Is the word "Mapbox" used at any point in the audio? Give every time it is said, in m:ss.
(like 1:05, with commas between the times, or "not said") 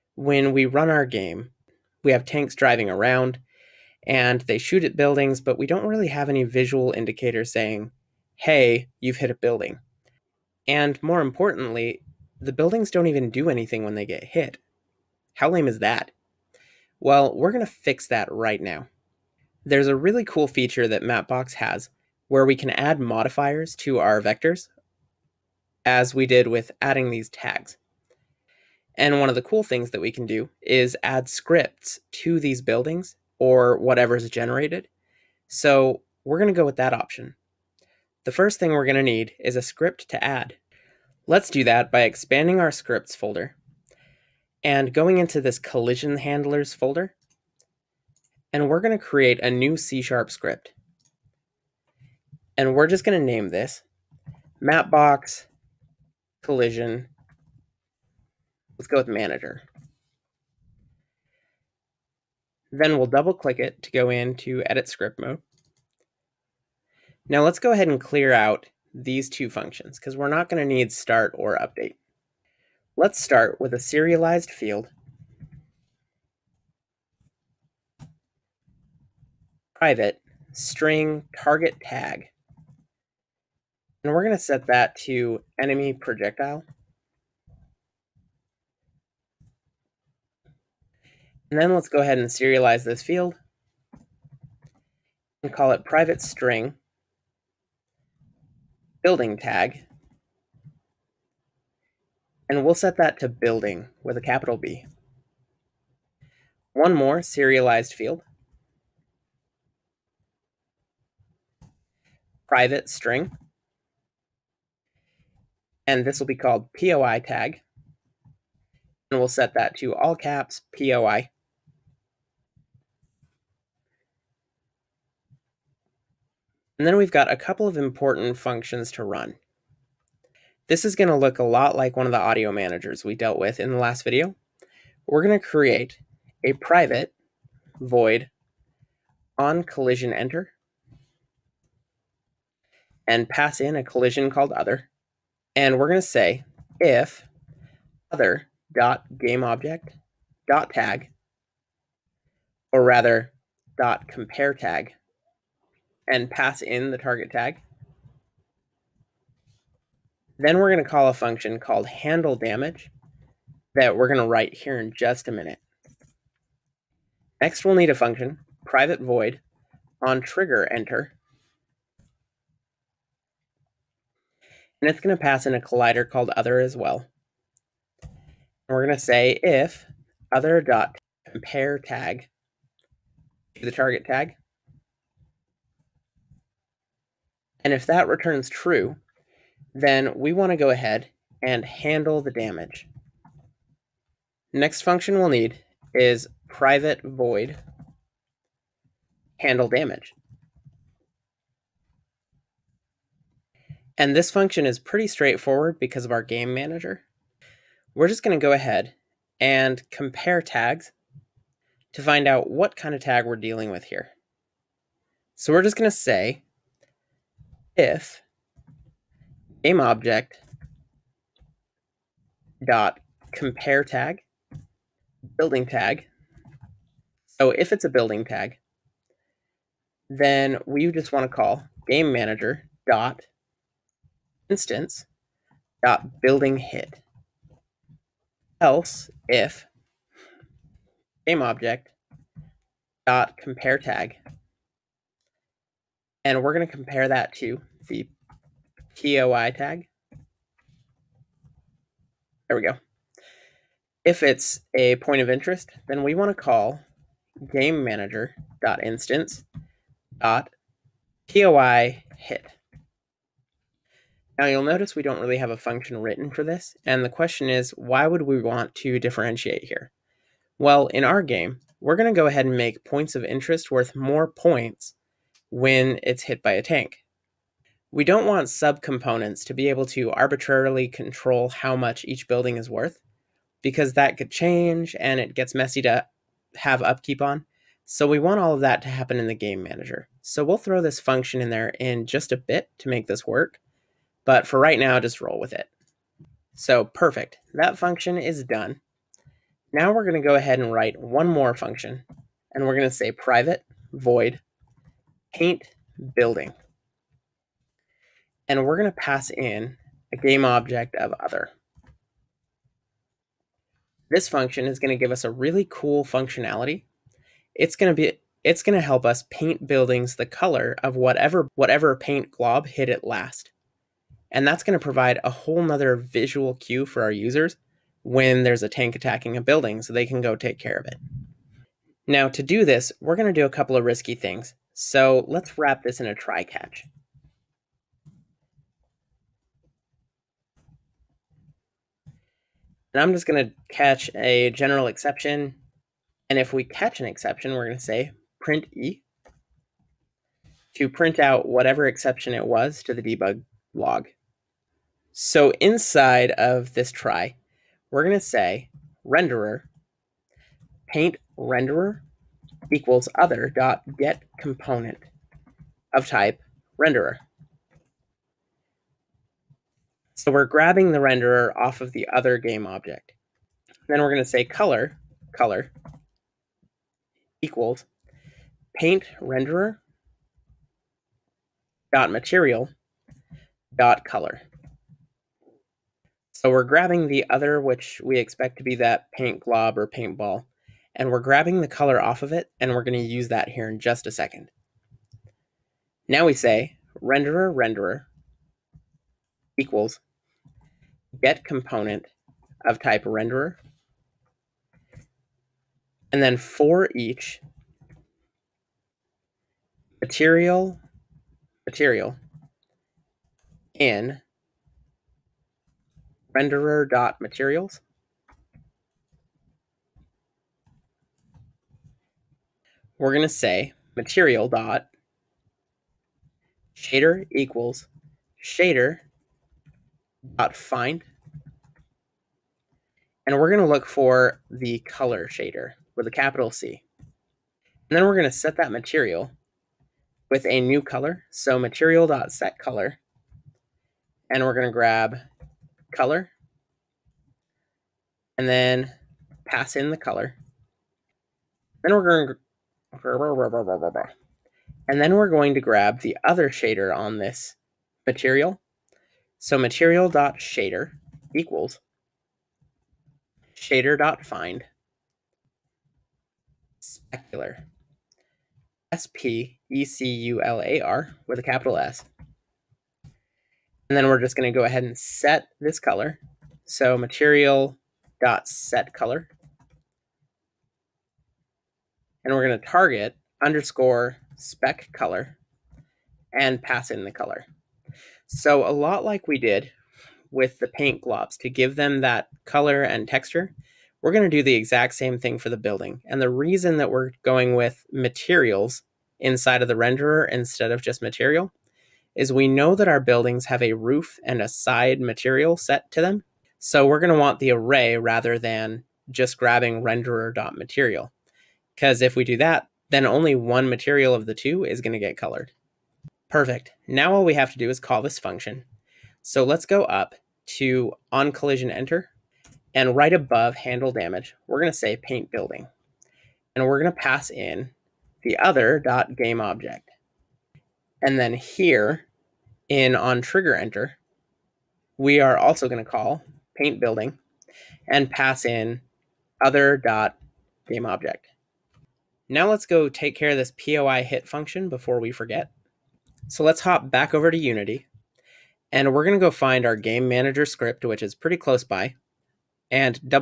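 0:21, 0:54.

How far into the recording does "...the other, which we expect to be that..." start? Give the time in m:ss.
6:27.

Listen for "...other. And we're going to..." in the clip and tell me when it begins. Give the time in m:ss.
2:24.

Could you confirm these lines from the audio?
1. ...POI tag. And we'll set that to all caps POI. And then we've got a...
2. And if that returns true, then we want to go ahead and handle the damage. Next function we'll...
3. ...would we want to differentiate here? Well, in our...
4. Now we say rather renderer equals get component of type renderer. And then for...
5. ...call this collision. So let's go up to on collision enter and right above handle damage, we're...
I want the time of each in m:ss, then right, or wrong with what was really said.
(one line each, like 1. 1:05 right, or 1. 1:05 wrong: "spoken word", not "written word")
1. 1:56 right
2. 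3:07 right
3. 4:28 right
4. 6:36 wrong: "renderer", not "rather"
5. 8:37 wrong: "function", not "collision".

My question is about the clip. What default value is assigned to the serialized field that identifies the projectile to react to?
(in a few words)
enemy projectile.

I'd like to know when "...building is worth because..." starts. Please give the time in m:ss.
4:42.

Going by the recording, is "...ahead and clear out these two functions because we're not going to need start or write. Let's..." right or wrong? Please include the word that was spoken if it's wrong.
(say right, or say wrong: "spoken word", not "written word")
wrong: "update", not "write".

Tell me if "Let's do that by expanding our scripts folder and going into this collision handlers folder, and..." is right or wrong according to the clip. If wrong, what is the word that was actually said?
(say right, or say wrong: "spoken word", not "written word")
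right.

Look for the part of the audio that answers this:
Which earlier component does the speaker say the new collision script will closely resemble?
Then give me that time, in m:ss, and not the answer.
2:12.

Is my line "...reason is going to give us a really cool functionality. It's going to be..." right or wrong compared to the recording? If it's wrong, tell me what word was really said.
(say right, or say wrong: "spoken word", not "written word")
wrong: "function", not "reason".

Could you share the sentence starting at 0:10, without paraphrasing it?
And more importantly, the buildings don't even do anything when they get hit.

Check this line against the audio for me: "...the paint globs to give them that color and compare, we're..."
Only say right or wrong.
wrong.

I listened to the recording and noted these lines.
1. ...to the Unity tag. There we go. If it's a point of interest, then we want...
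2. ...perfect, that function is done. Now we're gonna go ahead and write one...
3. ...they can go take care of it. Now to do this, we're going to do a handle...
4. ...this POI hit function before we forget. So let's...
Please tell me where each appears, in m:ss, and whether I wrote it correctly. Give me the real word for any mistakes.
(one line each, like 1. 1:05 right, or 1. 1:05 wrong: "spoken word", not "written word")
1. 4:07 wrong: "POI", not "Unity"
2. 4:56 right
3. 5:29 wrong: "couple", not "handle"
4. 9:03 right.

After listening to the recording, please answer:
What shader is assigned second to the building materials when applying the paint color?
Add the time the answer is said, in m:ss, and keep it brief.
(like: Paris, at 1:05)
Specular, at 7:46.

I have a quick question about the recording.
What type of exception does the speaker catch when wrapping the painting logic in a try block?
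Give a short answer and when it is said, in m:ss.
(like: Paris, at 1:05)
general exception, at 5:44.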